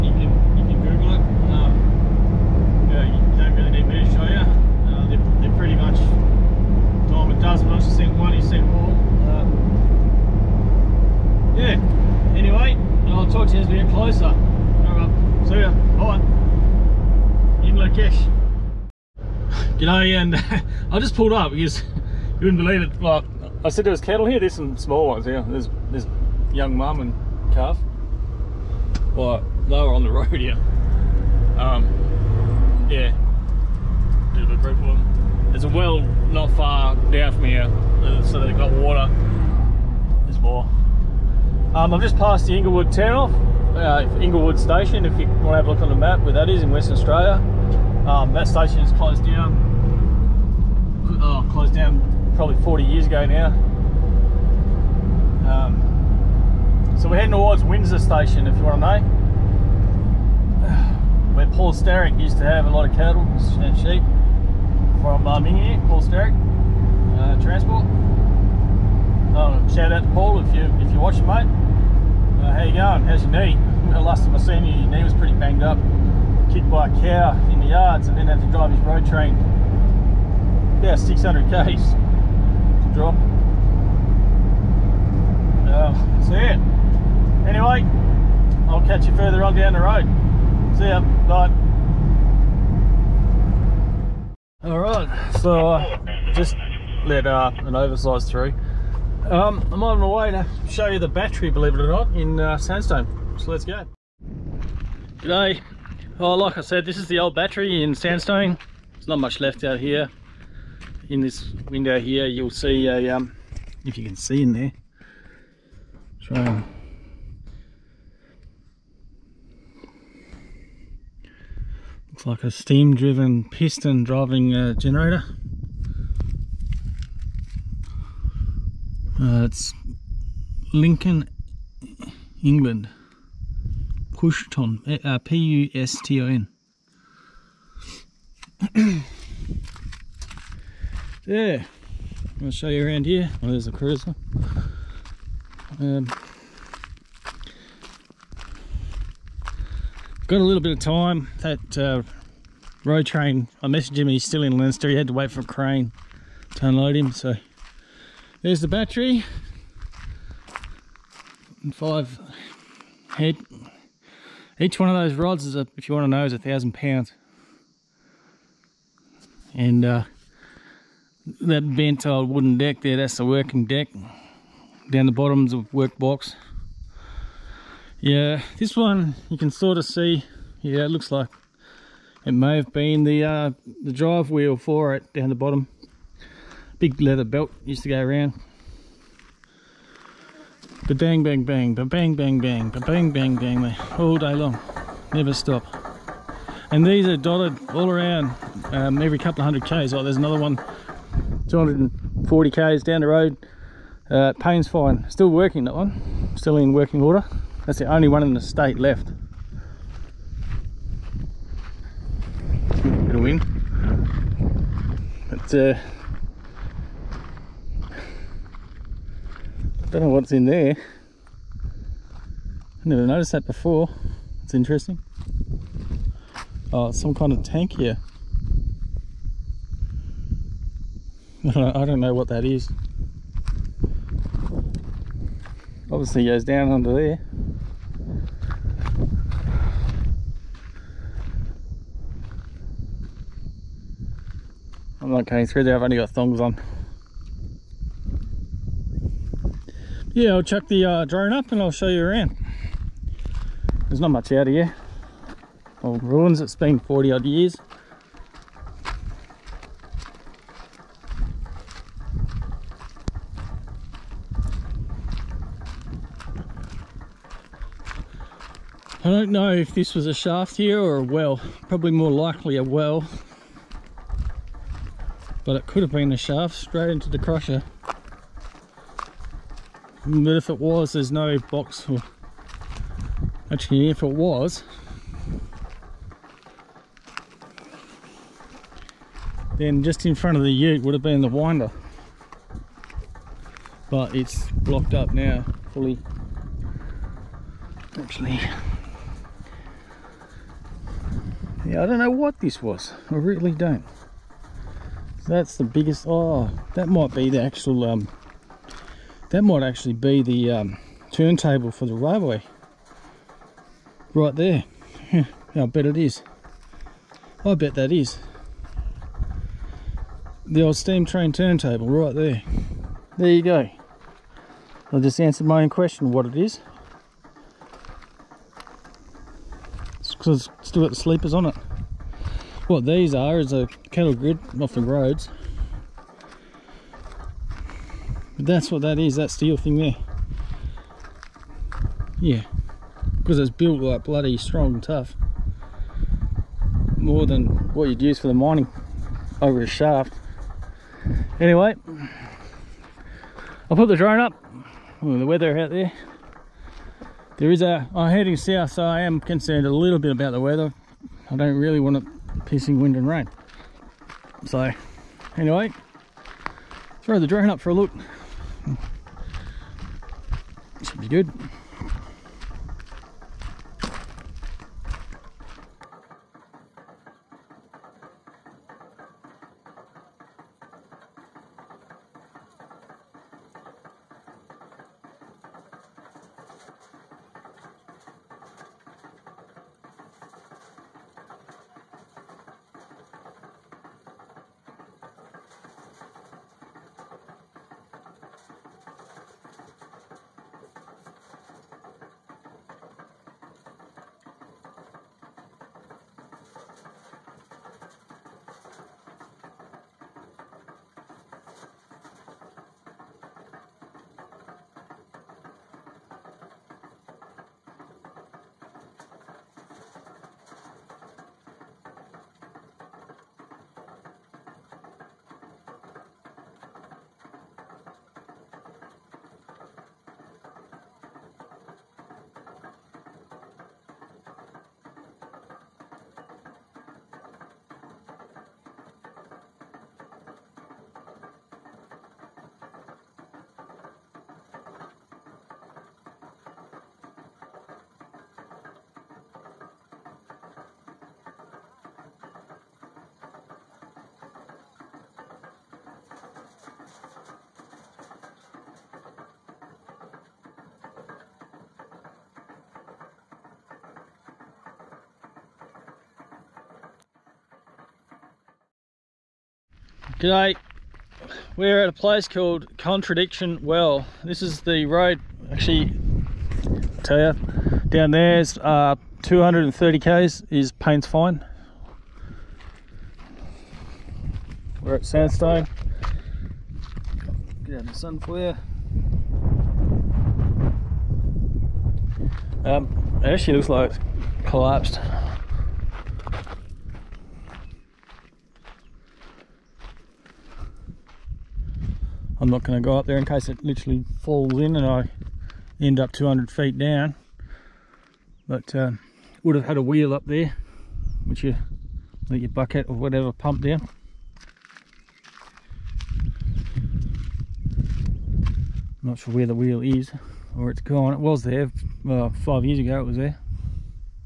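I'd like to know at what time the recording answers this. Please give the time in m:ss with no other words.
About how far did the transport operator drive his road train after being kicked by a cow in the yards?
1:20.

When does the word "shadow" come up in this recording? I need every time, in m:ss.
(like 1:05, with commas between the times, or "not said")
not said.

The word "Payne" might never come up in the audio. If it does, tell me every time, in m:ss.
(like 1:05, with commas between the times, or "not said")
3:24, 8:00.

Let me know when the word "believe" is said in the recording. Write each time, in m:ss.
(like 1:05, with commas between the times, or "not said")
0:22, 1:41.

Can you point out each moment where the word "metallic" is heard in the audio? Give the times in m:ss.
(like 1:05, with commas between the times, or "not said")
not said.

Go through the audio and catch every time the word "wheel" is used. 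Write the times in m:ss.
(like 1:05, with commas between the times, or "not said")
3:04, 8:29, 8:39.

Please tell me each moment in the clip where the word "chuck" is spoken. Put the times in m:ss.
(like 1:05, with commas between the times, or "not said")
4:10.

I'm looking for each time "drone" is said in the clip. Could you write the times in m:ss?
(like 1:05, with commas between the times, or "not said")
4:11, 5:53, 6:07.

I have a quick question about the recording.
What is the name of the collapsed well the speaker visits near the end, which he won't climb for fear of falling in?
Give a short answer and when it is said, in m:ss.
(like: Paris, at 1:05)
Contradiction Well, at 7:52.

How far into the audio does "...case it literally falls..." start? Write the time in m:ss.
8:23.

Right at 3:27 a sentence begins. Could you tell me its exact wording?
That's the only one in the state left.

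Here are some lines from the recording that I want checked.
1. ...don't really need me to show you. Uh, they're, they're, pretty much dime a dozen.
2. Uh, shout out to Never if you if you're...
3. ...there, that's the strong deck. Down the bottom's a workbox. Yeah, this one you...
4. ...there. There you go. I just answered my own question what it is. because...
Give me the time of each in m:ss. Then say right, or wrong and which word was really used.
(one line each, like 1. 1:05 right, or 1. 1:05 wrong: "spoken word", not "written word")
1. 0:03 right
2. 1:09 wrong: "Paul", not "Never"
3. 2:52 wrong: "working", not "strong"
4. 5:22 right.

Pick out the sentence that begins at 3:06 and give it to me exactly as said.
Big leather belt used to go around.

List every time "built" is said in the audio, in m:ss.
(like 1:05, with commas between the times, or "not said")
5:43.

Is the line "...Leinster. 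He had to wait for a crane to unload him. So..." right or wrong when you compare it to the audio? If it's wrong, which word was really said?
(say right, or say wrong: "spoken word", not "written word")
right.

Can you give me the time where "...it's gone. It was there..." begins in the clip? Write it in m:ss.
8:40.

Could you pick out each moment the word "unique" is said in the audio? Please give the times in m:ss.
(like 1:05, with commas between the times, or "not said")
not said.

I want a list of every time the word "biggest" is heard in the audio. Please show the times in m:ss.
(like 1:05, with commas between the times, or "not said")
5:05.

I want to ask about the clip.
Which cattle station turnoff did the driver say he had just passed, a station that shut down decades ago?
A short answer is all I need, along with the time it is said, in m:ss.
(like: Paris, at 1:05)
Inglewood Station, at 0:44.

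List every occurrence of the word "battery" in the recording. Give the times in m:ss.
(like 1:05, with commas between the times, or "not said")
1:41, 1:47, 2:38.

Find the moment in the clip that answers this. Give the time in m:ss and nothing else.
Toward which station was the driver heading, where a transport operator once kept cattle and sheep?
0:57.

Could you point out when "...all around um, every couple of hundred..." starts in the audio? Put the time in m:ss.
3:17.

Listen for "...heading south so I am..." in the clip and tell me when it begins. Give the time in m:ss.
5:58.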